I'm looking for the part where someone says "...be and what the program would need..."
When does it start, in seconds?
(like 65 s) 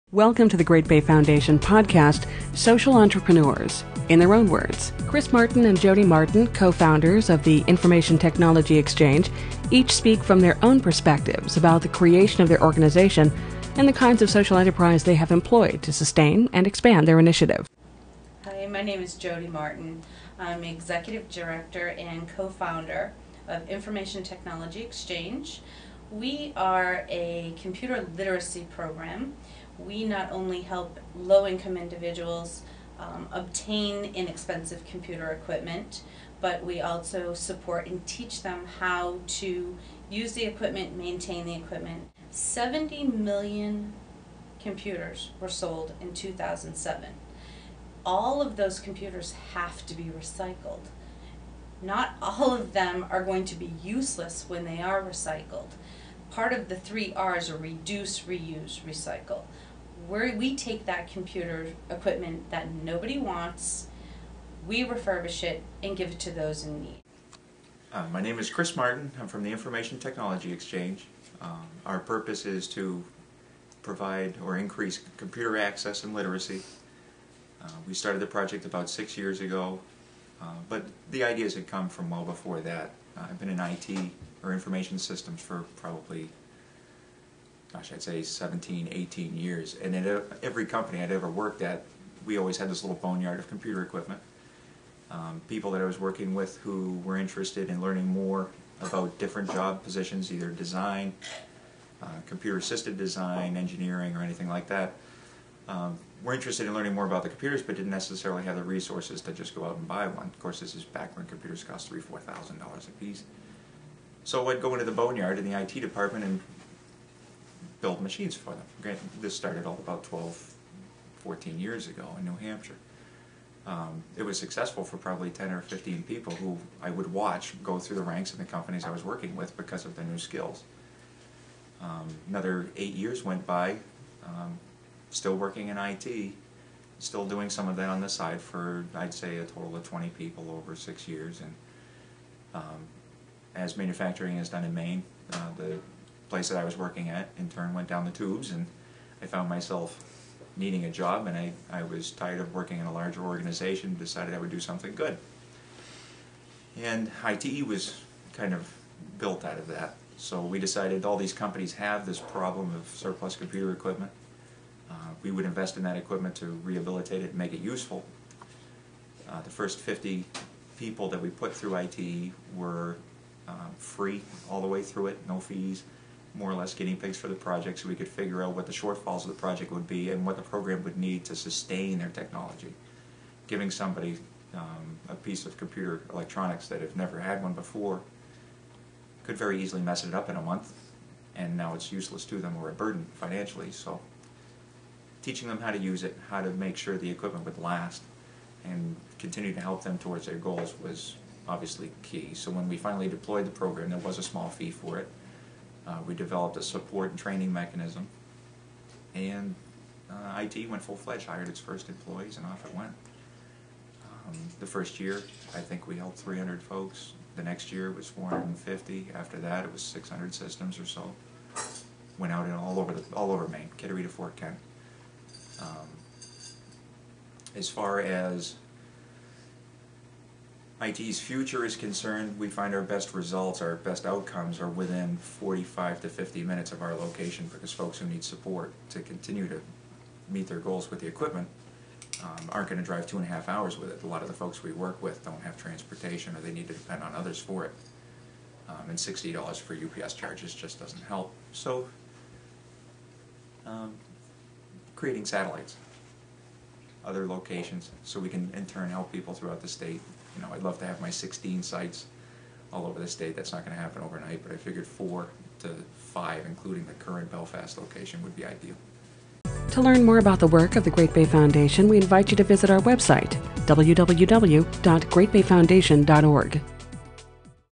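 179 s.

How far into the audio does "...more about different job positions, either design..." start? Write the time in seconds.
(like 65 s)
98 s.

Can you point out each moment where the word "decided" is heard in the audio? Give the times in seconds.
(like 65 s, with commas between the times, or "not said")
153 s, 160 s.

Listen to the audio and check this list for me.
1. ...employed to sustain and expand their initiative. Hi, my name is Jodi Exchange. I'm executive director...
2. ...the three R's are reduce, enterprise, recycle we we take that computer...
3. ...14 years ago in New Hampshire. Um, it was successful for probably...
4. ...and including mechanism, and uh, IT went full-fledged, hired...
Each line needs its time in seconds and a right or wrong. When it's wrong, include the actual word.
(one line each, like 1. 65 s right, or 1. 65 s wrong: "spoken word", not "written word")
1. 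15 s wrong: "Martin", not "Exchange"
2. 56 s wrong: "reuse", not "enterprise"
3. 121 s right
4. 207 s wrong: "training", not "including".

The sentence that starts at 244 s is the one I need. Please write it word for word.
A lot of the folks we work with don't have transportation or they need to depend on others for it.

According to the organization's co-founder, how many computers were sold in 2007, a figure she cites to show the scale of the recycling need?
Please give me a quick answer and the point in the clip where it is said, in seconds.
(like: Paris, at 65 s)
70 million, at 42 s.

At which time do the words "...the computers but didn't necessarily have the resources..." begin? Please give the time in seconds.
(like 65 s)
107 s.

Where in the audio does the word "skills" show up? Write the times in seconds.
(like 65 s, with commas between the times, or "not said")
130 s.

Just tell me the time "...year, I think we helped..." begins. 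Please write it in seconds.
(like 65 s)
214 s.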